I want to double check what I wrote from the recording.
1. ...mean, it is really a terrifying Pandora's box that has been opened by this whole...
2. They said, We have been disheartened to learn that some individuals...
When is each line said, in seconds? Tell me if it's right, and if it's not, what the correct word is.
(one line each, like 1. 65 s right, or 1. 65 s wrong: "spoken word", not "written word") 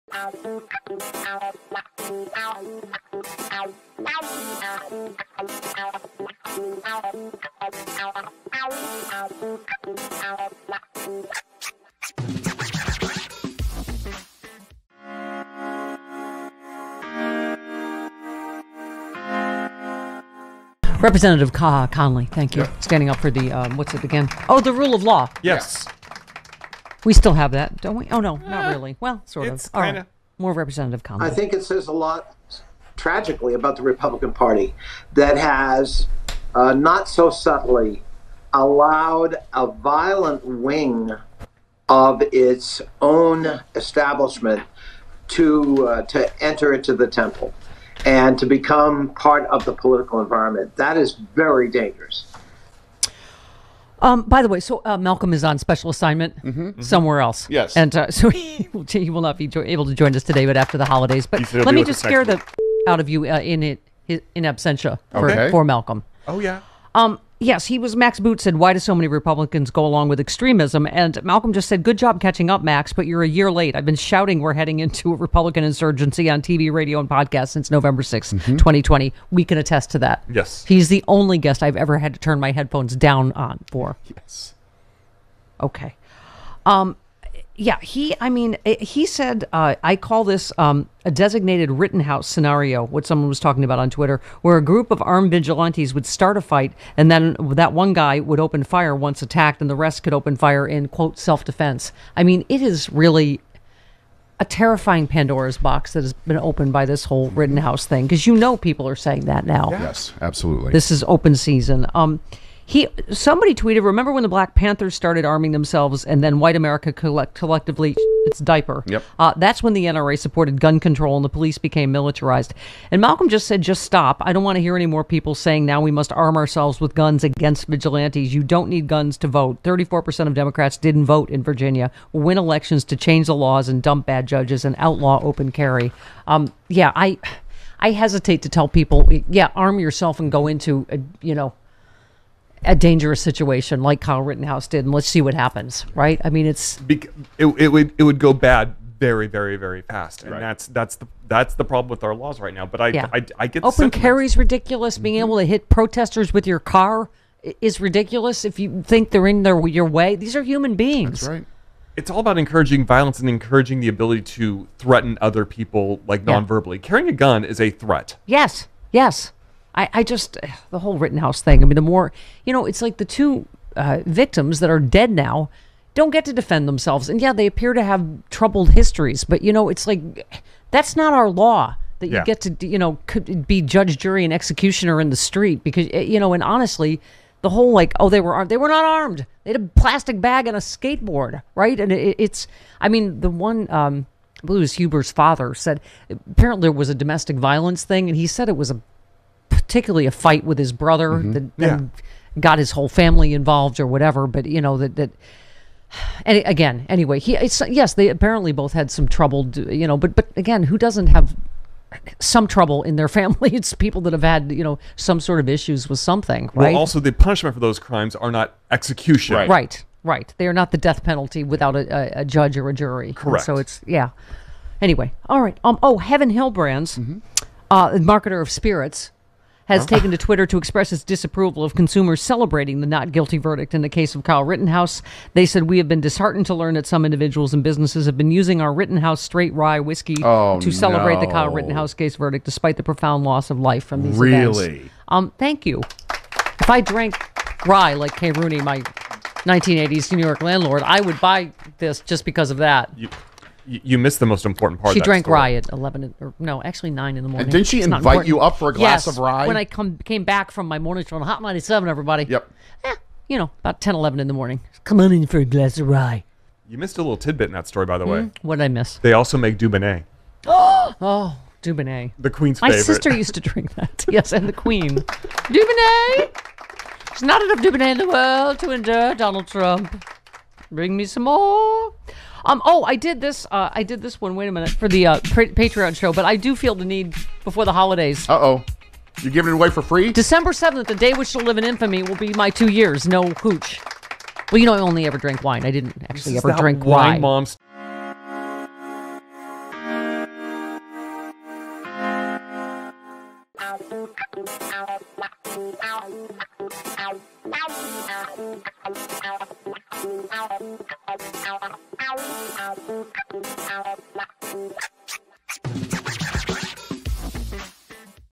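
1. 102 s right
2. 235 s right.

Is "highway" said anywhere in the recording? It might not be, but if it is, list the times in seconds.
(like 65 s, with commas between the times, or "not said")
not said.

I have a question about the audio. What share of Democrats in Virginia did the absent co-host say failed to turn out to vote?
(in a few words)
34%.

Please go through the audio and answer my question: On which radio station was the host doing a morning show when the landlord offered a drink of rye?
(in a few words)
Hot 97.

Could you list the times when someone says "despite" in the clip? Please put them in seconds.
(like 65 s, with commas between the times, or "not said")
242 s.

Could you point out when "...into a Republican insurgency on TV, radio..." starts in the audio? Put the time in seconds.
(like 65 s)
74 s.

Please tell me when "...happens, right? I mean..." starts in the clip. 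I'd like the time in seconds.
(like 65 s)
145 s.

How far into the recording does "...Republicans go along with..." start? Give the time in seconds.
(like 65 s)
69 s.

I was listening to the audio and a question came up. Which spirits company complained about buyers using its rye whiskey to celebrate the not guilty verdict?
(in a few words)
Heaven Hill.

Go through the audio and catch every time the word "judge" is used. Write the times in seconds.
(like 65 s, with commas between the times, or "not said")
134 s, 183 s, 222 s.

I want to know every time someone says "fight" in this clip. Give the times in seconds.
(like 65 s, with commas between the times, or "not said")
96 s, 200 s.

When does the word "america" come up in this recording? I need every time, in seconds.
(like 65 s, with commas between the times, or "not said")
116 s.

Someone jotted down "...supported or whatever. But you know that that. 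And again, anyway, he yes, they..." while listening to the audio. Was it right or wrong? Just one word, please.
wrong.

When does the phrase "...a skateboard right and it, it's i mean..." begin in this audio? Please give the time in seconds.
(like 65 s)
190 s.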